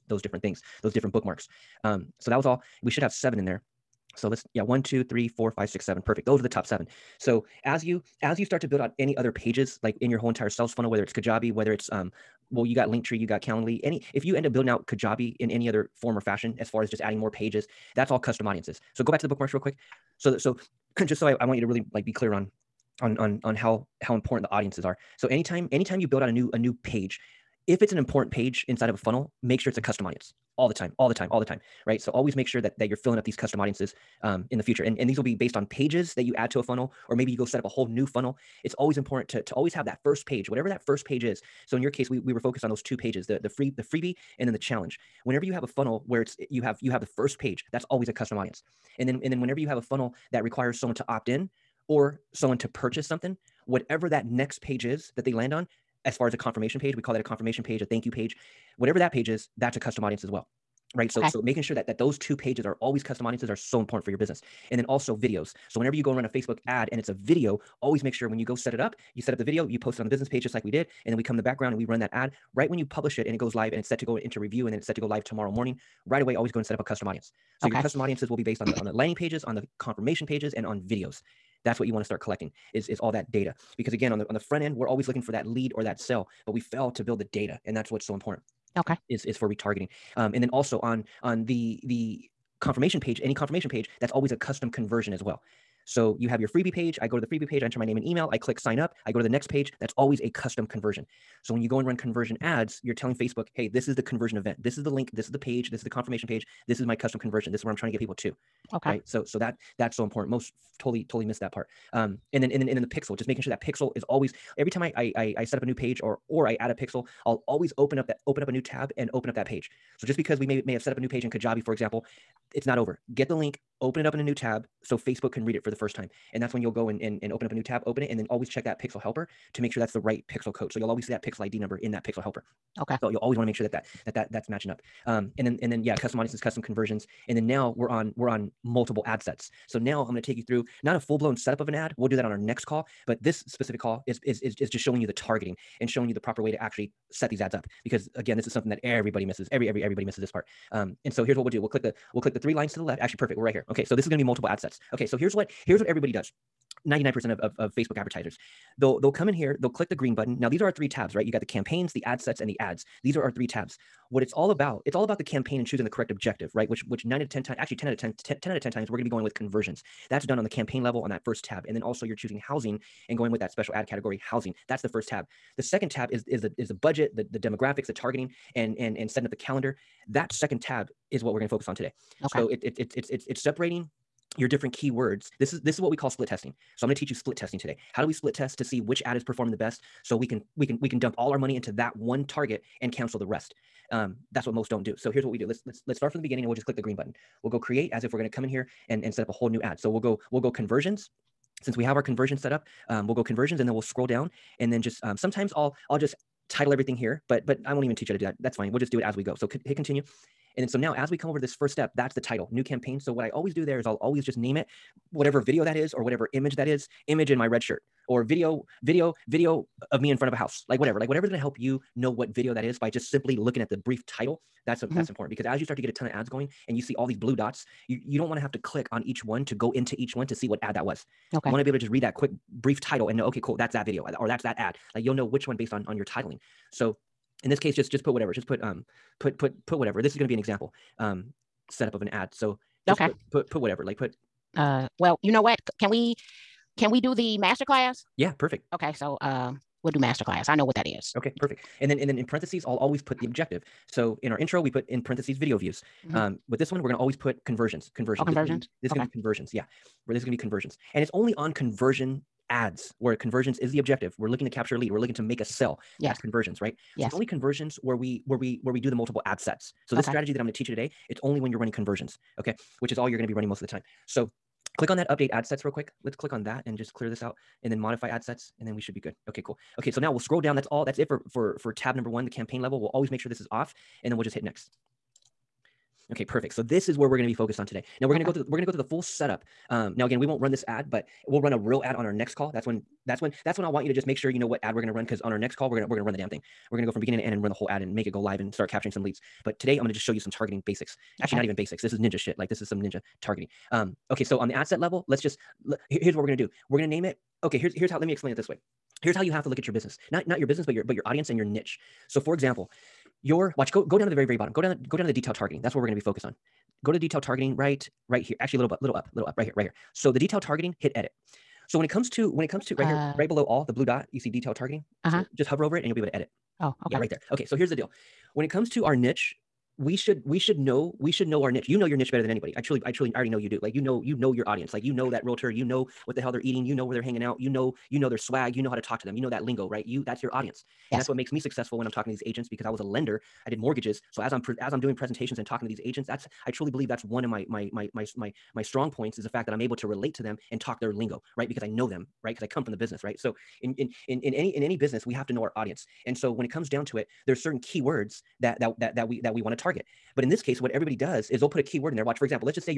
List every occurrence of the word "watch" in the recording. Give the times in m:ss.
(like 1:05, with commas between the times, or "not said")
5:13, 6:02.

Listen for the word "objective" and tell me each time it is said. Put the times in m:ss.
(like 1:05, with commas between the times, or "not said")
2:46, 4:13, 4:23.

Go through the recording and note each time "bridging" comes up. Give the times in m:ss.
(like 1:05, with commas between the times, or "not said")
not said.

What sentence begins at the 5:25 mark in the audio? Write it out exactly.
So just hover over it and you'll be able to edit Oh, okay.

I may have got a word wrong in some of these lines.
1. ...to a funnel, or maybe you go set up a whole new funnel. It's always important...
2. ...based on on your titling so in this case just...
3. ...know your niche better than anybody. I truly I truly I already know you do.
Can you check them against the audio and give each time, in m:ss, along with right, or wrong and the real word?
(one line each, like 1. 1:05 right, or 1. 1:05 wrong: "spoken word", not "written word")
1. 0:36 right
2. 3:55 right
3. 5:31 right.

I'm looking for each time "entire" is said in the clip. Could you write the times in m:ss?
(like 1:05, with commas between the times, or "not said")
0:10.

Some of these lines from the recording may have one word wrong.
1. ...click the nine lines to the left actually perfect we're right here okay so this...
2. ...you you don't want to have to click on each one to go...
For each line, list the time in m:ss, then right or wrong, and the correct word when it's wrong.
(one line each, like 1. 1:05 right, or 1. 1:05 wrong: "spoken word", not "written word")
1. 2:32 wrong: "three", not "nine"
2. 3:47 right.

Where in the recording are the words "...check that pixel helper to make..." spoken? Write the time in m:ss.
2:08.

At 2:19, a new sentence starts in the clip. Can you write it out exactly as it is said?
So now I'm going to take you through not a full blown setup of an ad.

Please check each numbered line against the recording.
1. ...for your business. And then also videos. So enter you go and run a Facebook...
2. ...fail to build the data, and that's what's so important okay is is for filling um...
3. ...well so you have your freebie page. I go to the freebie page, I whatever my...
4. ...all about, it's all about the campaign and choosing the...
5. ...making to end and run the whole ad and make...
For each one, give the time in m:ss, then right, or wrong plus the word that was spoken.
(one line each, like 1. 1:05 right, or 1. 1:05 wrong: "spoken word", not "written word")
1. 1:04 wrong: "whenever", not "enter"
2. 1:26 wrong: "retargeting", not "filling"
3. 1:35 wrong: "enter", not "whatever"
4. 2:44 right
5. 4:56 wrong: "beginning", not "making".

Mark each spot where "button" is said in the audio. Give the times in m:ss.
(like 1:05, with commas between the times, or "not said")
2:40, 3:16.